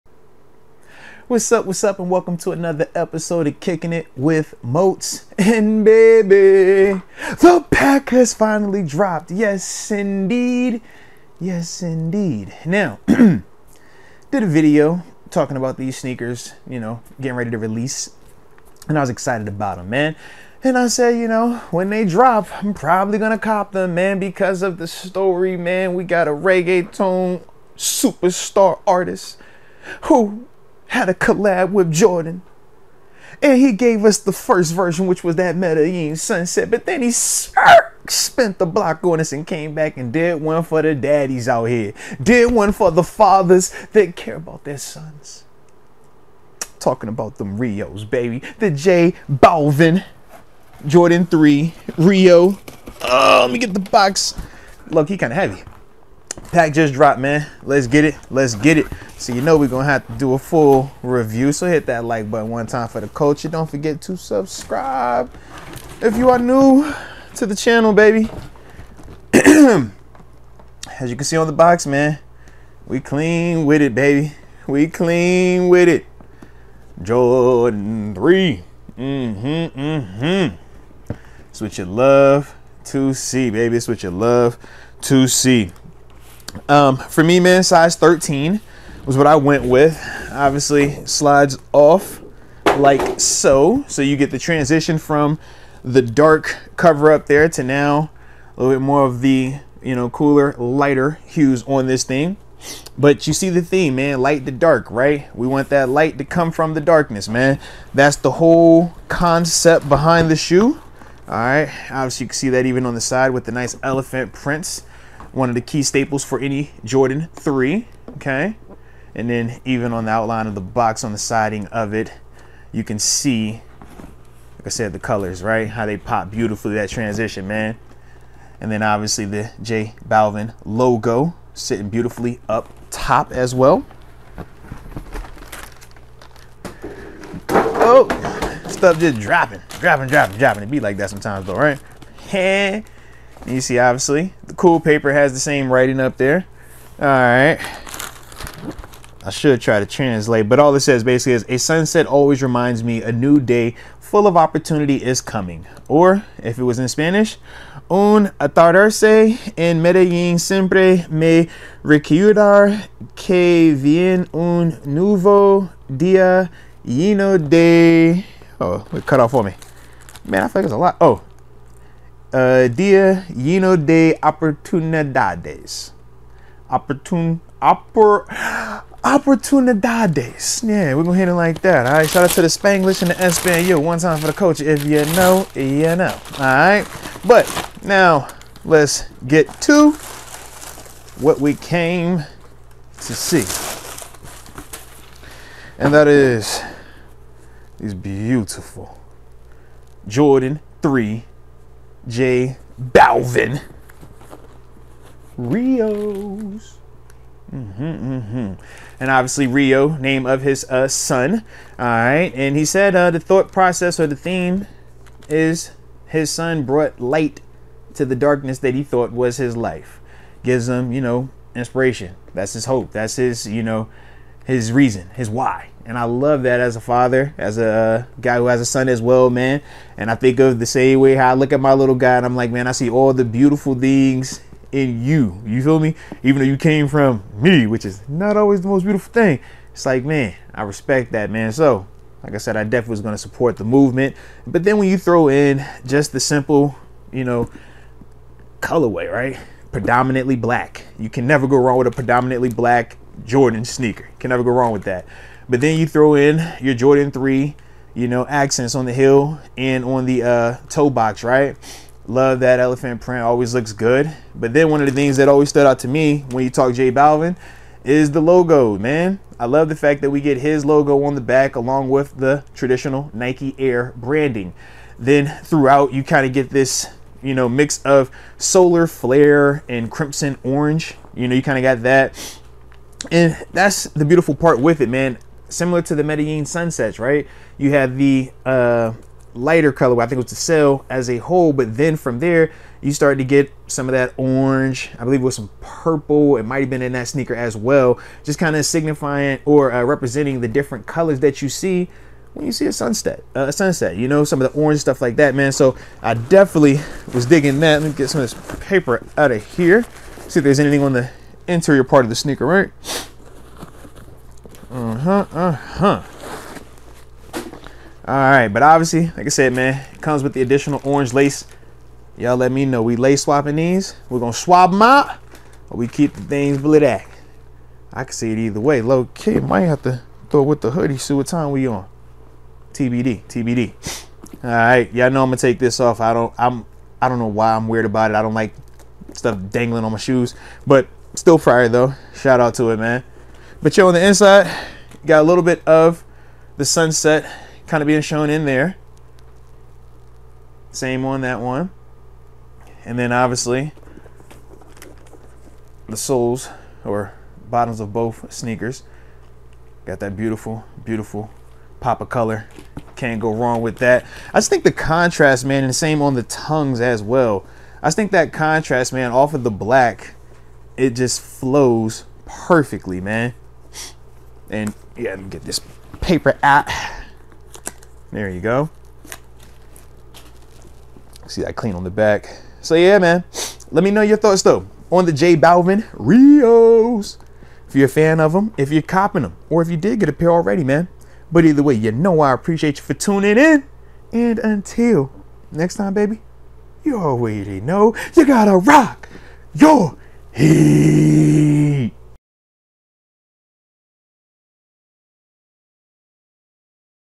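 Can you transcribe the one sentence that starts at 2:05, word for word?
How they pop beautifully, that transition, man.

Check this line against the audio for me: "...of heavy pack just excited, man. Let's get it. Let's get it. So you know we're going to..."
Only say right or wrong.
wrong.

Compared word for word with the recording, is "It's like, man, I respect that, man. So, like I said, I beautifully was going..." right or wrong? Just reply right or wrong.
wrong.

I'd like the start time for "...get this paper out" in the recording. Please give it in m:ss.
6:15.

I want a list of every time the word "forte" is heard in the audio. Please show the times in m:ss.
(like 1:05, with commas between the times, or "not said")
not said.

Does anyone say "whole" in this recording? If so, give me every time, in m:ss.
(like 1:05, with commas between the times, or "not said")
1:48, 4:51.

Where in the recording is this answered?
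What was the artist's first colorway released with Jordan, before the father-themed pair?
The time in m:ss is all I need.
0:35.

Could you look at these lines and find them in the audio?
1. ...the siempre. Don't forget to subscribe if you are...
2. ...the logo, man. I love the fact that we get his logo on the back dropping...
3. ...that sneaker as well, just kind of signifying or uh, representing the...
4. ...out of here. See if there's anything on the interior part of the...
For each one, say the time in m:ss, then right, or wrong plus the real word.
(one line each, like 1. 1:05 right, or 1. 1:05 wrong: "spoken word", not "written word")
1. 1:02 wrong: "culture", not "siempre"
2. 4:28 wrong: "along", not "dropping"
3. 4:56 right
4. 5:09 right.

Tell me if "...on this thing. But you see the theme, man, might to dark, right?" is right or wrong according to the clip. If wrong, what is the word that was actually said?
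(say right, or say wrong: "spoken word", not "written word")
wrong: "light", not "might".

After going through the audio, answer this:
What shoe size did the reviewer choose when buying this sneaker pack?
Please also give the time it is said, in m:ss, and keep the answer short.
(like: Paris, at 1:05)
13, at 1:27.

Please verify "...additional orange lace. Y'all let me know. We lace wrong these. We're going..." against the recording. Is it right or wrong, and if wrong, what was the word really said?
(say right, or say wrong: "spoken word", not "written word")
wrong: "swapping", not "wrong".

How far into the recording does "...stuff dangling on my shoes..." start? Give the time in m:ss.
5:39.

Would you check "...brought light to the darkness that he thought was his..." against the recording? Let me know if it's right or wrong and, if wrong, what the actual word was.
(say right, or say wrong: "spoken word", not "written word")
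right.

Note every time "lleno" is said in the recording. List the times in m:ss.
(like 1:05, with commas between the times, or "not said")
2:46, 2:53.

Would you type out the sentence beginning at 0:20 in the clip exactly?
And I said, you know, when they drop, I'm probably gonna cop them, man, because of the story, man.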